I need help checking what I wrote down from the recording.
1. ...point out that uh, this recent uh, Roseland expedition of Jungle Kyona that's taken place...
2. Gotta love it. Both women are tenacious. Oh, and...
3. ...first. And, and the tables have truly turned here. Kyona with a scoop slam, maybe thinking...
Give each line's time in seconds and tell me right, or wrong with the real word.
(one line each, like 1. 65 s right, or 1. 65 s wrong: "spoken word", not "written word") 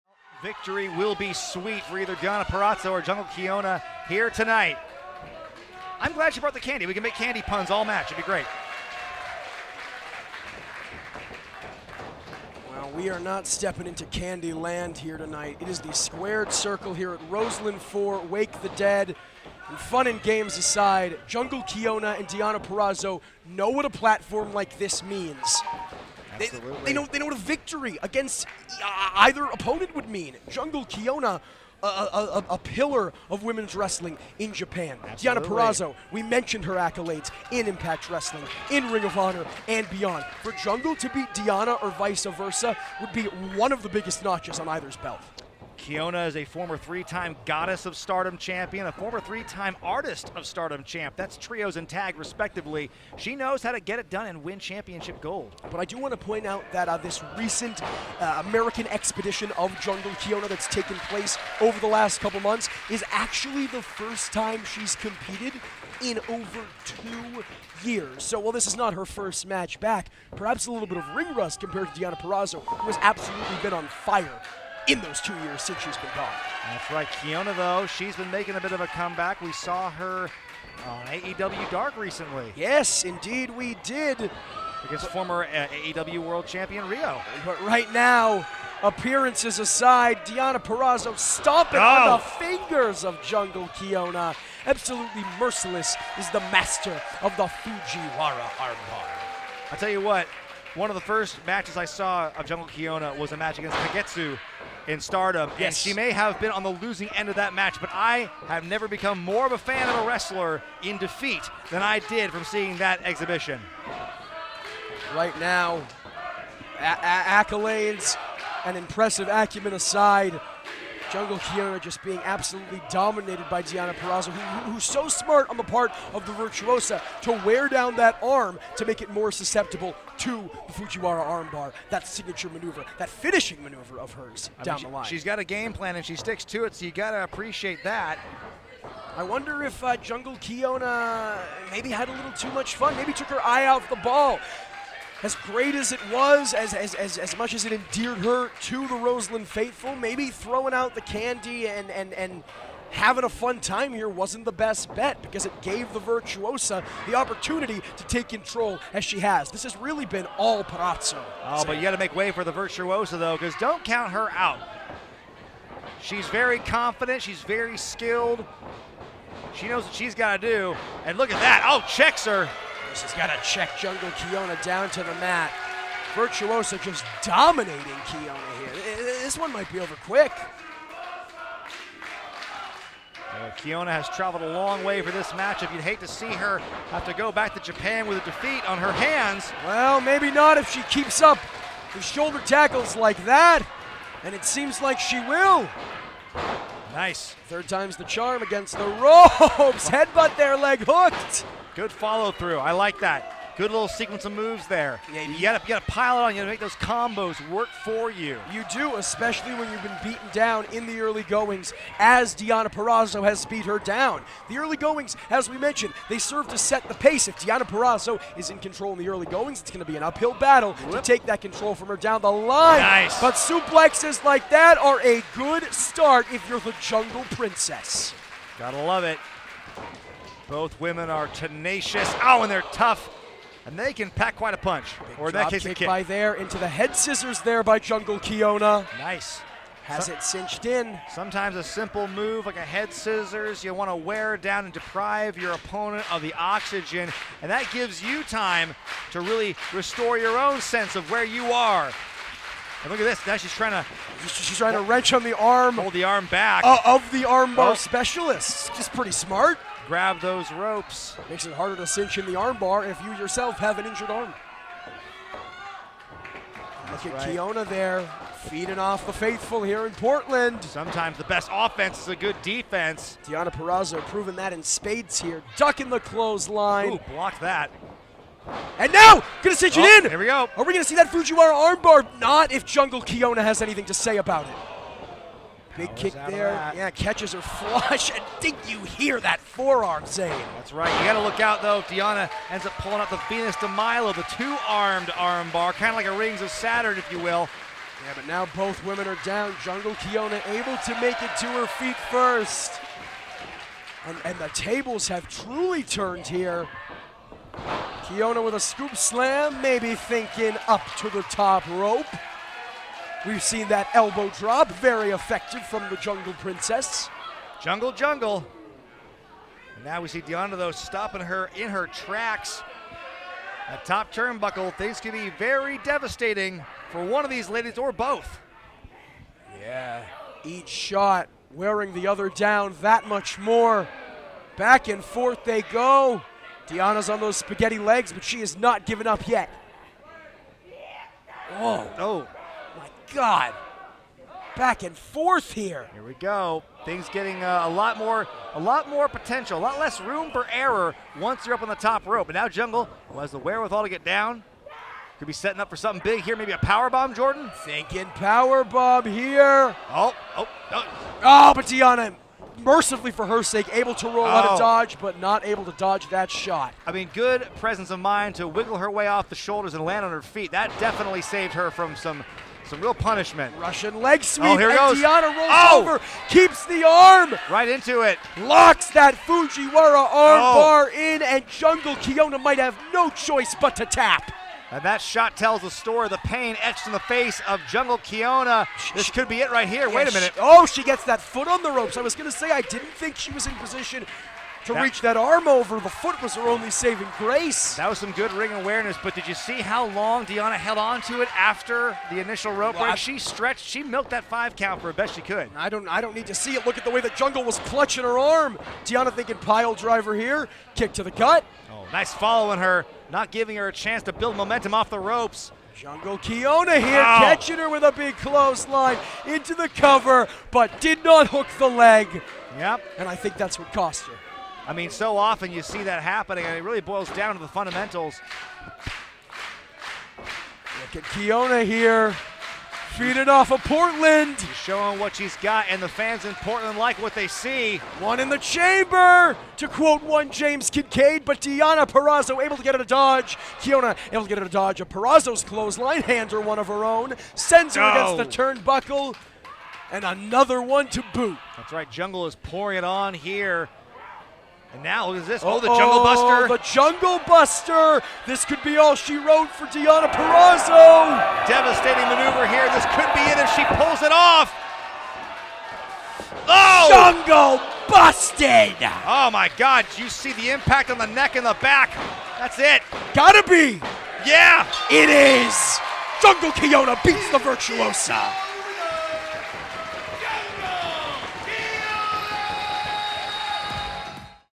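1. 56 s wrong: "American", not "Roseland"
2. 228 s right
3. 302 s right.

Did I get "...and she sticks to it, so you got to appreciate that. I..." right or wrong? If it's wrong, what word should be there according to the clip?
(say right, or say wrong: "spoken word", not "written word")
right.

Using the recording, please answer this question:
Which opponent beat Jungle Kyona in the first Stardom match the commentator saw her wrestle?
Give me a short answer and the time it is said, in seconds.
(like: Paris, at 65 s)
Kagetsu, at 103 s.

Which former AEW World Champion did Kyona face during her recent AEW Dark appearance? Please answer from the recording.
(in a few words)
Riho.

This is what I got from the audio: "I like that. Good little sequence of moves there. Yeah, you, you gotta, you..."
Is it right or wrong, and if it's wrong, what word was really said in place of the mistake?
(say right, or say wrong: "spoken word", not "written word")
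right.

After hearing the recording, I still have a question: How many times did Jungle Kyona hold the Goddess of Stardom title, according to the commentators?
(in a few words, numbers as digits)
3.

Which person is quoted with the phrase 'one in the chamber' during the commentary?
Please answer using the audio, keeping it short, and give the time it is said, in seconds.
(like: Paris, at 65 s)
James Kincaid, at 440 s.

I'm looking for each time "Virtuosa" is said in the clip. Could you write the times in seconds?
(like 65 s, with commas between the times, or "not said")
126 s, 155 s, 162 s, 176 s, 477 s.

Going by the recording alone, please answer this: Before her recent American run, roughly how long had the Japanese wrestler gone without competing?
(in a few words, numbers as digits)
2 years.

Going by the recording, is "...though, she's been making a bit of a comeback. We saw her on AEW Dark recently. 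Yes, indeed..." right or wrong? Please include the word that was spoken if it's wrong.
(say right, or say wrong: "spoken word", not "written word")
right.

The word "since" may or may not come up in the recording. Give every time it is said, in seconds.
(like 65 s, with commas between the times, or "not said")
75 s.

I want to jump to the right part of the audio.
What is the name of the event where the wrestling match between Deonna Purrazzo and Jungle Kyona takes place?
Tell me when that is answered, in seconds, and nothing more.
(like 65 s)
18 s.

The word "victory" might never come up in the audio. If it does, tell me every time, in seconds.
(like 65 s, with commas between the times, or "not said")
0 s, 27 s.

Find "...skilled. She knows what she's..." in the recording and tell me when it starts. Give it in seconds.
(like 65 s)
167 s.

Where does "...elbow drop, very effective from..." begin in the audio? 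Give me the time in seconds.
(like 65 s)
313 s.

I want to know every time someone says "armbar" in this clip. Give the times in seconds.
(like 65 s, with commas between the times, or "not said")
98 s, 131 s, 257 s, 262 s, 281 s, 295 s, 380 s.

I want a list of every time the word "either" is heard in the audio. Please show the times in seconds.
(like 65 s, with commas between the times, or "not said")
1 s, 29 s, 44 s.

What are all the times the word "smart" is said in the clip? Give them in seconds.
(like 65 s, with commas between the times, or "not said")
125 s, 259 s.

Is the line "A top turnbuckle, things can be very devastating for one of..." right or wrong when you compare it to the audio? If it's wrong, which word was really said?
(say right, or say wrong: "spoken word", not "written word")
right.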